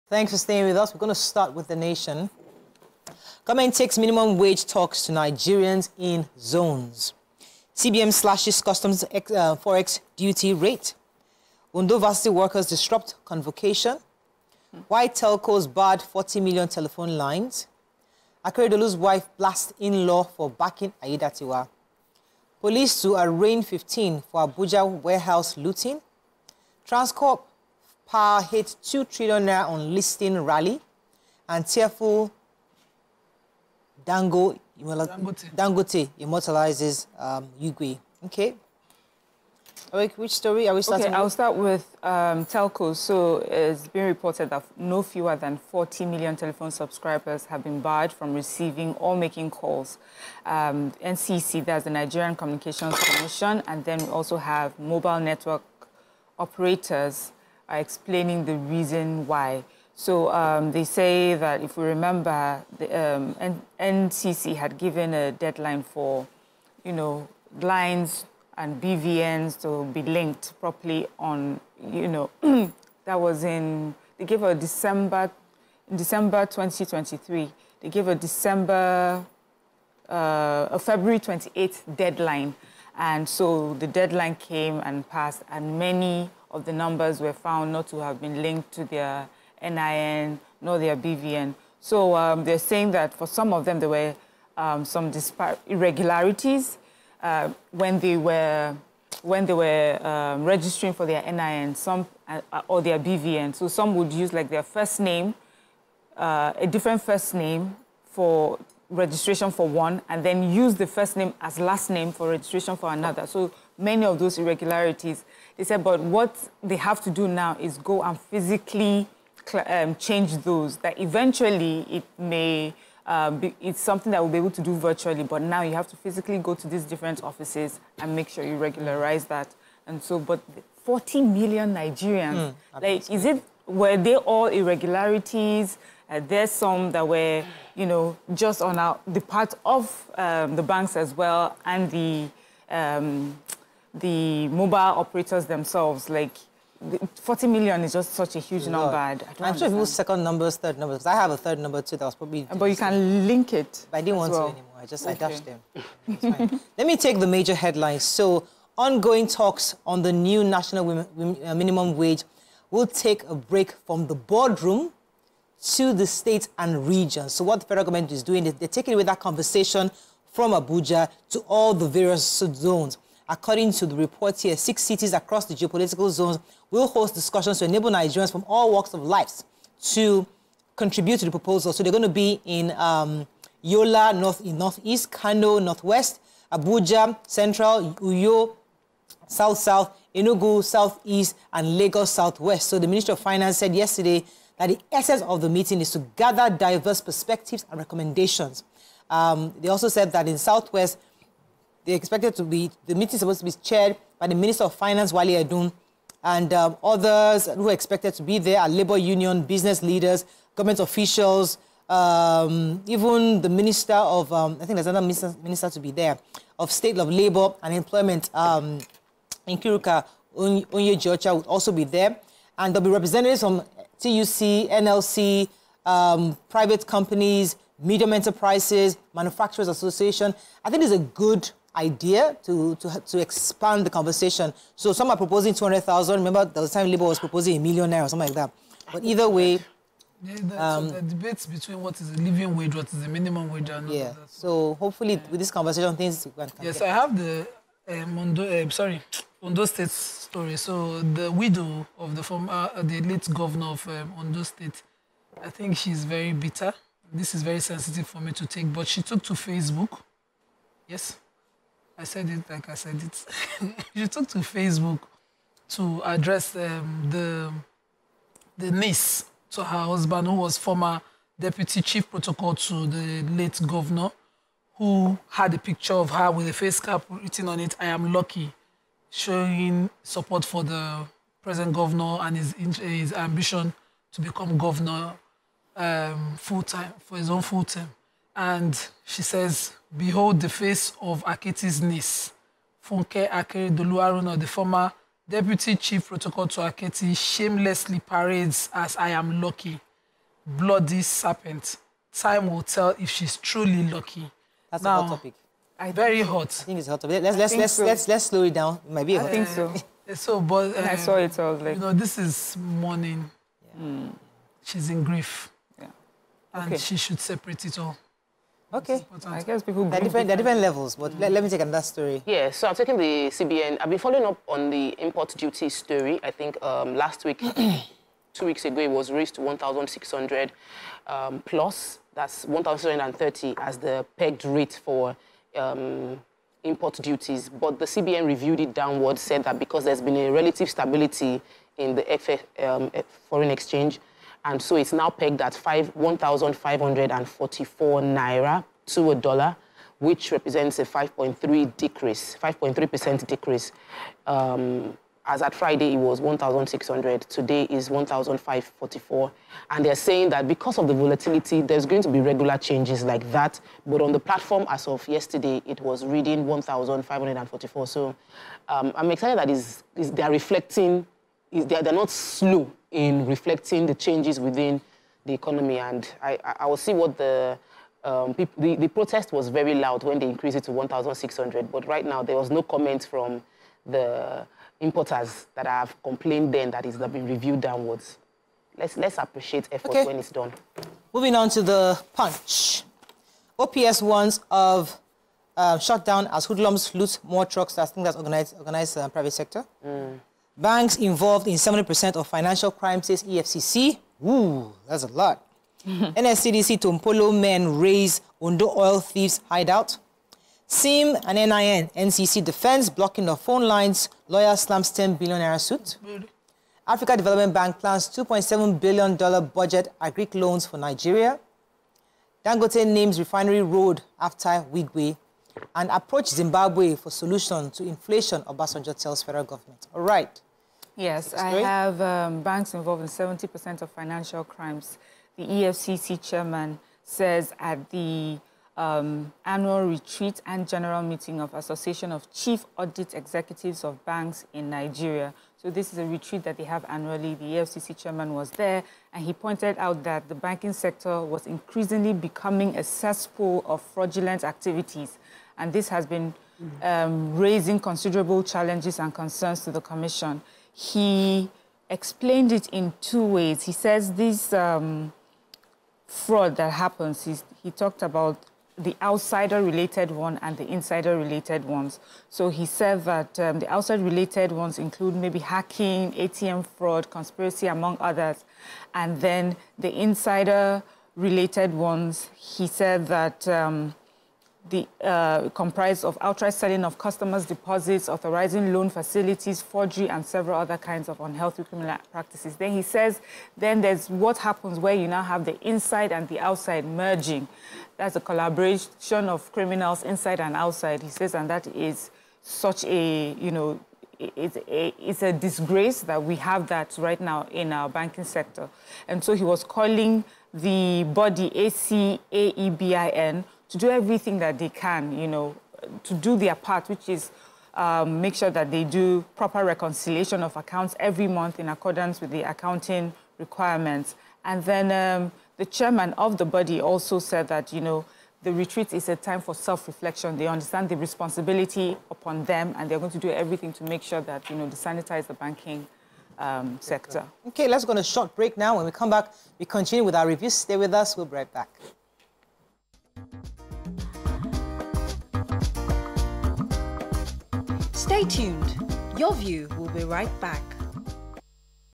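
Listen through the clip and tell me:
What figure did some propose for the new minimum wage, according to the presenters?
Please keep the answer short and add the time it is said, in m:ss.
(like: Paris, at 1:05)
200,000, at 3:55.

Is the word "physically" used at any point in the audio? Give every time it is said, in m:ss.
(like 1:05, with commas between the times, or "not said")
1:58, 2:05.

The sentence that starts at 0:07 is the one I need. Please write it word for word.
CBN slashes customs ex, uh, forex duty rate.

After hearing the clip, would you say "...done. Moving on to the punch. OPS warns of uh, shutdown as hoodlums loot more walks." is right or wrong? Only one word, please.
wrong.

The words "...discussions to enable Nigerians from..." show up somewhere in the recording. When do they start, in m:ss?
2:57.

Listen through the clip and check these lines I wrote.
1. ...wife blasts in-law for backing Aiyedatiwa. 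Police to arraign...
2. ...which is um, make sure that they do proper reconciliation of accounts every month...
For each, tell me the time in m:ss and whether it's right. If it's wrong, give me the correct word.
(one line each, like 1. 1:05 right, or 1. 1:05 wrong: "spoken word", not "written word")
1. 0:18 right
2. 8:36 right.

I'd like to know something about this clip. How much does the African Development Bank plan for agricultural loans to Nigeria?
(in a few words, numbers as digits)
$2.7 billion.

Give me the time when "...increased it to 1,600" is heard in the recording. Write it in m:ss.
6:20.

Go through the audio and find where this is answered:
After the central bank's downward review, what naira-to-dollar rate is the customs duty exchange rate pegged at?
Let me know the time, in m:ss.
5:45.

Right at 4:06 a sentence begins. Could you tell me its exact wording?
I have the um, Mondo, uh, um, sorry, Ondo State story.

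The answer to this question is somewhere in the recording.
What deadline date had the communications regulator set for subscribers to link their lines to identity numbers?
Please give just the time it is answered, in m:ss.
1:20.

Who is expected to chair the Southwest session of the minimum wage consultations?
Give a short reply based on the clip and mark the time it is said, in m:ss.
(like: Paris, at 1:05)
Wale Edun, at 3:25.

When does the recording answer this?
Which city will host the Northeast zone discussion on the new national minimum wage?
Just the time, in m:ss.
3:03.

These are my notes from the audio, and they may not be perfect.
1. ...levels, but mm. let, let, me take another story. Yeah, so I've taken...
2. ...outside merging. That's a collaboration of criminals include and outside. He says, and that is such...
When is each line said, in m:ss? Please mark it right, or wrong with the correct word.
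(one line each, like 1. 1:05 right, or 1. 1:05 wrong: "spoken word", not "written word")
1. 5:20 right
2. 8:16 wrong: "inside", not "include".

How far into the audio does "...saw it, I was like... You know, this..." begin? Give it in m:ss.
5:10.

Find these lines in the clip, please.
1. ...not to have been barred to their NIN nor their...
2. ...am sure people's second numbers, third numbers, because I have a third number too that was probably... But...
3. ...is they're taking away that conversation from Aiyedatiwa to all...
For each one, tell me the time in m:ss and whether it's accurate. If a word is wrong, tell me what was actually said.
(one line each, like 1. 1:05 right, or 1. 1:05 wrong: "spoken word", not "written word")
1. 1:27 wrong: "linked", not "barred"
2. 2:29 right
3. 2:48 wrong: "Abuja", not "Aiyedatiwa".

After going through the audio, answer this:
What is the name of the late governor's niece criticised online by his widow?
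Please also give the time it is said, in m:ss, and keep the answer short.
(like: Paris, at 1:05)
Funke Akeredolu Aruna, at 4:52.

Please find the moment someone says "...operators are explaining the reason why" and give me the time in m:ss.
0:56.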